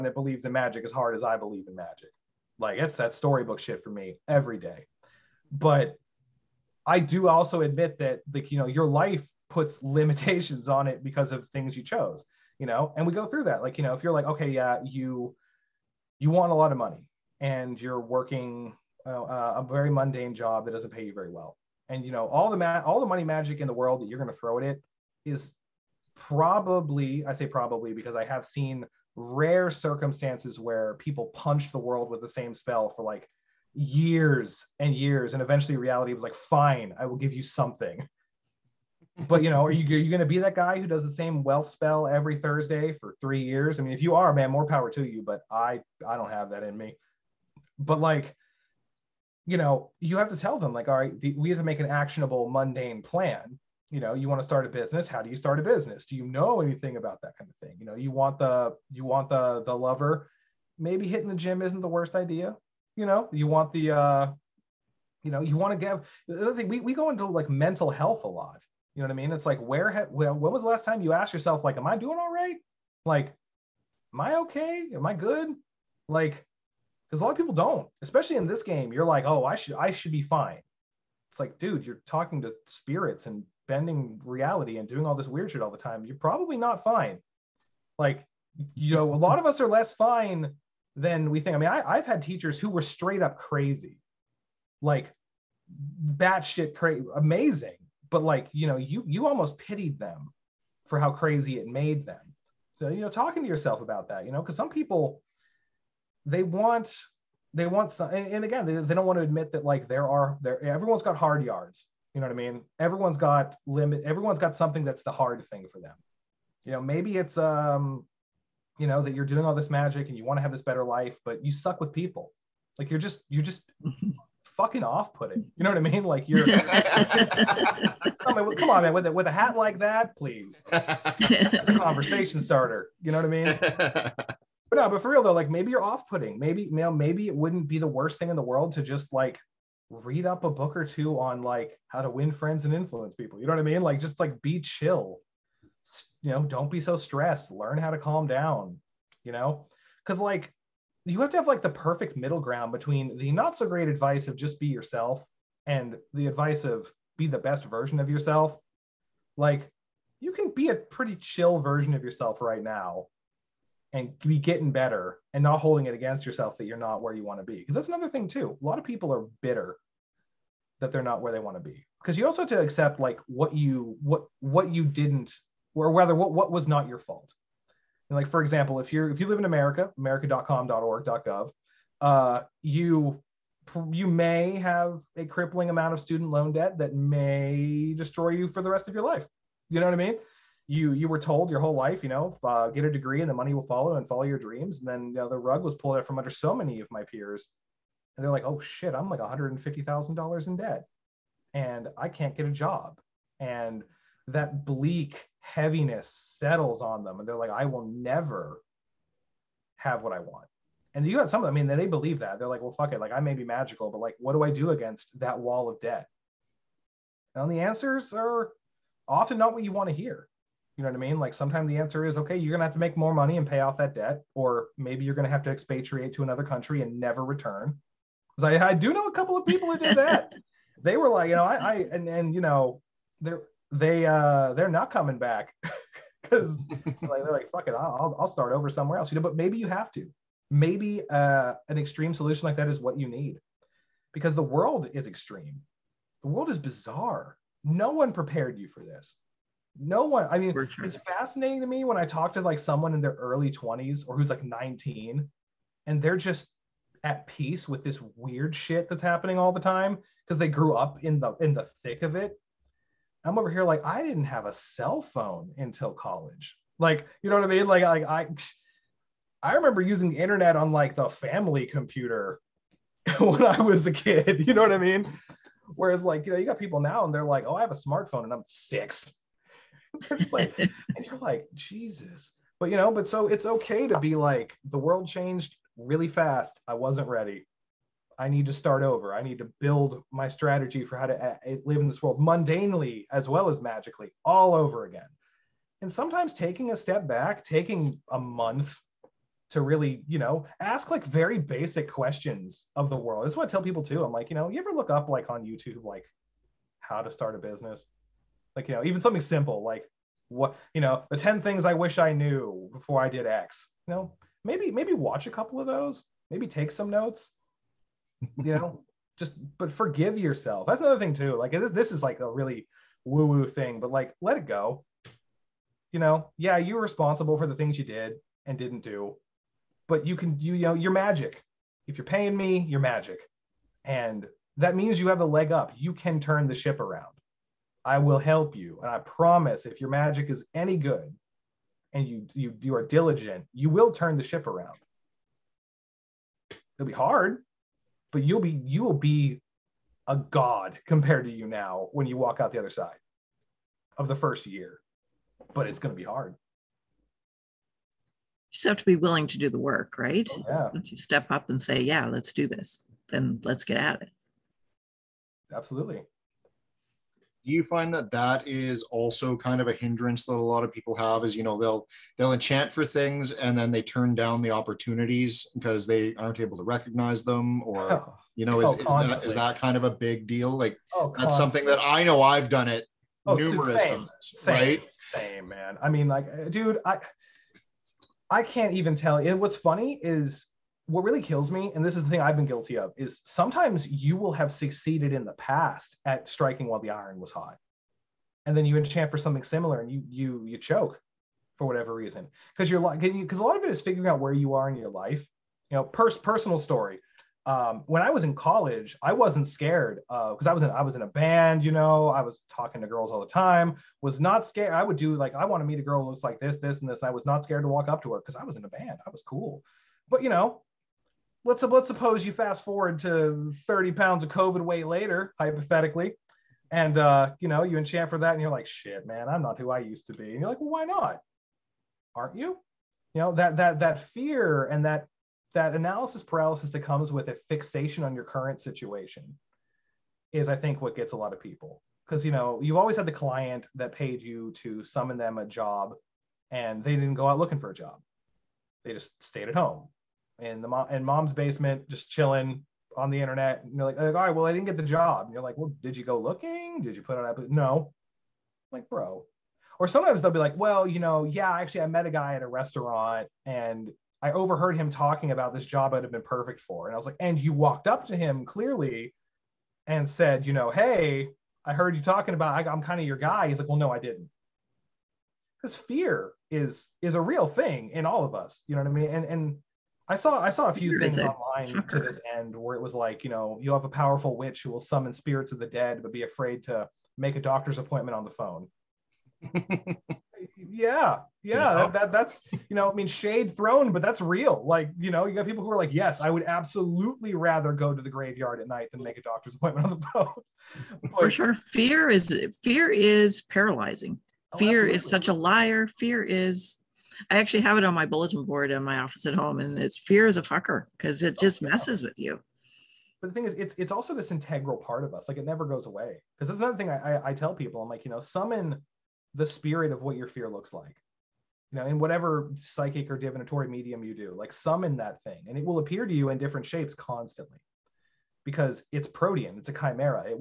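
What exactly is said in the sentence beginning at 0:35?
And eventually reality was like, fine, I will give you something.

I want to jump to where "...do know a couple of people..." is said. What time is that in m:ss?
3:48.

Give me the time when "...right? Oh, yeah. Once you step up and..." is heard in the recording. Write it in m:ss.
5:59.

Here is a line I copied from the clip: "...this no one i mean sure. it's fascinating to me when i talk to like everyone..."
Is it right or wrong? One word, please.
wrong.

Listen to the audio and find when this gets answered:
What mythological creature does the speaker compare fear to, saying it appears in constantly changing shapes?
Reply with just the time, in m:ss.
8:49.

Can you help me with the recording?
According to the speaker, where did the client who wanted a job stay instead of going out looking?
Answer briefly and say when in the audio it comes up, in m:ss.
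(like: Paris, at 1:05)
Mom's basement, at 7:31.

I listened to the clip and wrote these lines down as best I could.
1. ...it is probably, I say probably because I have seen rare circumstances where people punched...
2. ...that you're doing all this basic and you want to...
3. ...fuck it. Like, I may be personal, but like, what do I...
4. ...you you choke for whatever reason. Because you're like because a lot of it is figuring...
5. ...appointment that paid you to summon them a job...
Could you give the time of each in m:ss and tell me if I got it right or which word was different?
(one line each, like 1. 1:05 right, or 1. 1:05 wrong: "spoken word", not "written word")
1. 0:24 right
2. 1:59 wrong: "magic", not "basic"
3. 3:32 wrong: "magical", not "personal"
4. 6:40 right
5. 7:23 wrong: "client", not "appointment".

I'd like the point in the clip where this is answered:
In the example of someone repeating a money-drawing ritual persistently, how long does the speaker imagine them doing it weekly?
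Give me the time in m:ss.
0:43.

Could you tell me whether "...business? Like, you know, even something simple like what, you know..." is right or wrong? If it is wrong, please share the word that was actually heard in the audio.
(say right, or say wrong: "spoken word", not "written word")
right.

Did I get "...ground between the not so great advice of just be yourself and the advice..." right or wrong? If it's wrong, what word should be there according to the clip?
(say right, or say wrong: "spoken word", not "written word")
right.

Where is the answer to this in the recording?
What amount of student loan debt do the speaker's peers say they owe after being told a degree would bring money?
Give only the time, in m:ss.
3:19.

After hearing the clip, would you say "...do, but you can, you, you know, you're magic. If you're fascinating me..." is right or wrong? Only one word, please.
wrong.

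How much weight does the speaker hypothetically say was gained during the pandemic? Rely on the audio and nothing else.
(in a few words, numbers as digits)
30 pounds.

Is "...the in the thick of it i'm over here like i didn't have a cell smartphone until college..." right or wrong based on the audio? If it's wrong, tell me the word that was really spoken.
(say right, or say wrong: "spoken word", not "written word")
wrong: "phone", not "smartphone".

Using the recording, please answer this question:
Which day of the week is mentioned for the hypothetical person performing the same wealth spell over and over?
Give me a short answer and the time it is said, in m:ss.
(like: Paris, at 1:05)
Thursday, at 0:42.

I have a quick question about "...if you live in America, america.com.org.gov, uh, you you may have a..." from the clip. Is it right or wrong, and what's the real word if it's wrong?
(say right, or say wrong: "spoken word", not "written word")
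right.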